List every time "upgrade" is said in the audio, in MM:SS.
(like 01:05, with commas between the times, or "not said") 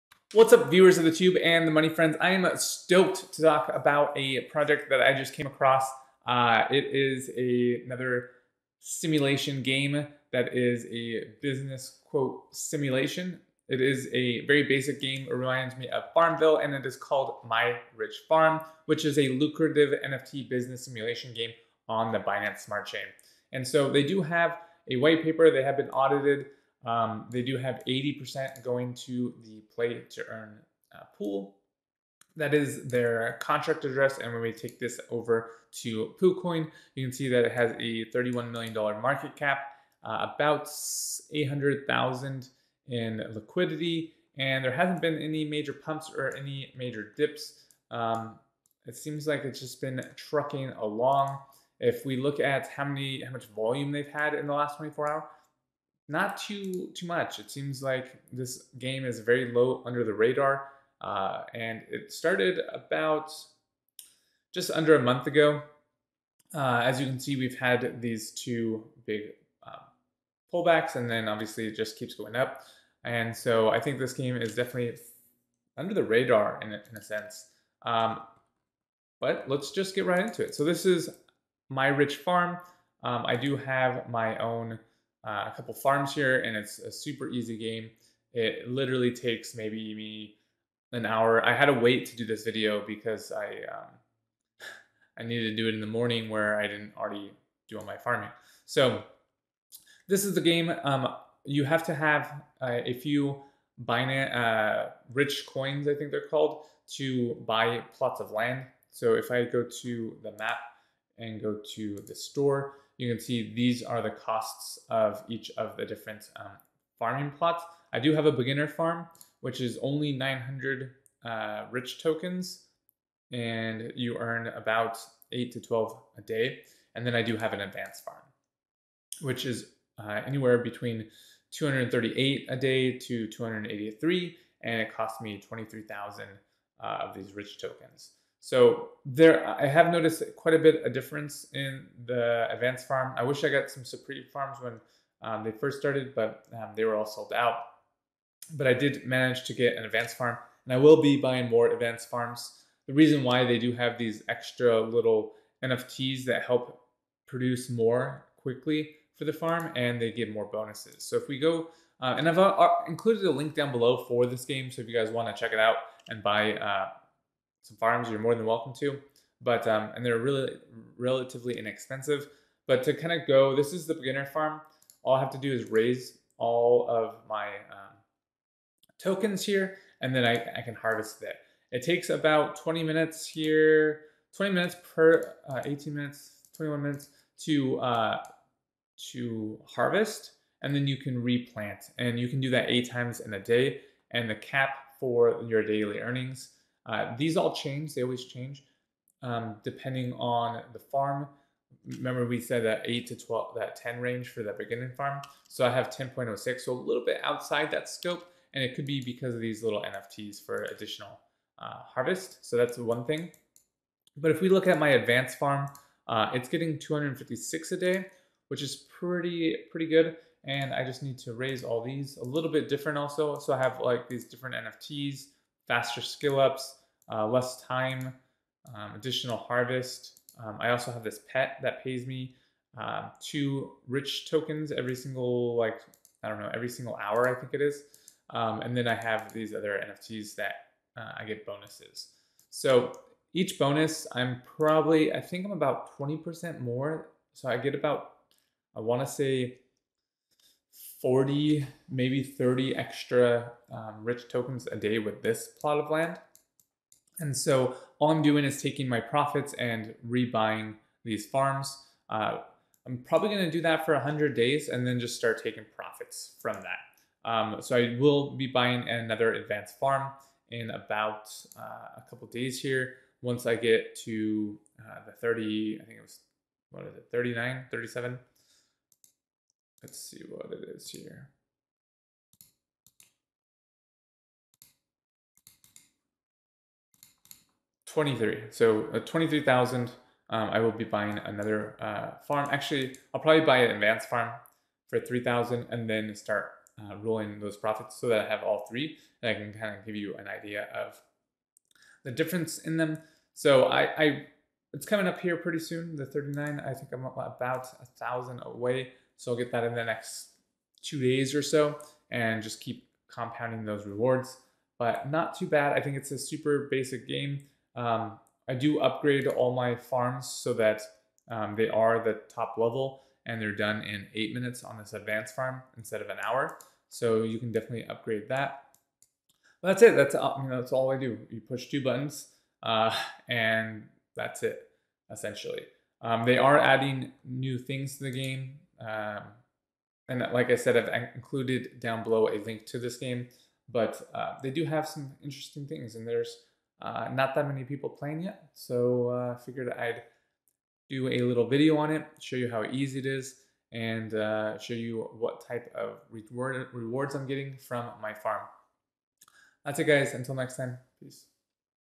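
05:18, 05:27.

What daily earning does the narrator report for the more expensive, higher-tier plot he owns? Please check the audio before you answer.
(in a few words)
256.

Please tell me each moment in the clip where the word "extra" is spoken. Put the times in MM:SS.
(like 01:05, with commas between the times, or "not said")
02:34, 04:12.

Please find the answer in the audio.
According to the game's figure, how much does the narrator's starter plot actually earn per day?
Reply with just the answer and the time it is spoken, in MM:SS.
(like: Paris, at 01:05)
10.06, at 03:25.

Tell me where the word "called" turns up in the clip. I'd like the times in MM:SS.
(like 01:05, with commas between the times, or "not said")
00:16, 01:46.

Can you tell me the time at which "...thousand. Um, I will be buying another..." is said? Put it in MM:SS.
04:49.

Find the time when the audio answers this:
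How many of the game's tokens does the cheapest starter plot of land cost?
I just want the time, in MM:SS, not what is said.
02:00.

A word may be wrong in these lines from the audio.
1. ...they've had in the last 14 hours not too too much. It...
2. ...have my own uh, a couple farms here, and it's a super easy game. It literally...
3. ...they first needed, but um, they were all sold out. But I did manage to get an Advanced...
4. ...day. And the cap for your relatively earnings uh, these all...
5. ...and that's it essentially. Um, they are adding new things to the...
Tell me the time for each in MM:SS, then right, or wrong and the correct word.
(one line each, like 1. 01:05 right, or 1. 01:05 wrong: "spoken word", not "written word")
1. 00:53 wrong: "24", not "14"
2. 01:23 right
3. 02:25 wrong: "started", not "needed"
4. 03:13 wrong: "daily", not "relatively"
5. 05:33 right.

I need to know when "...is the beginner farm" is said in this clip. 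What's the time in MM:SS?
02:53.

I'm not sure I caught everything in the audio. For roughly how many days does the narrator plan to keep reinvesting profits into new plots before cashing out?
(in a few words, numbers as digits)
100 days.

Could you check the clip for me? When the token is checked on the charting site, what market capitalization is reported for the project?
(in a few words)
$31 million.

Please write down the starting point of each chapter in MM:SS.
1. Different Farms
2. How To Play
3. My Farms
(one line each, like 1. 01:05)
1. 01:00
2. 02:00
3. 04:00.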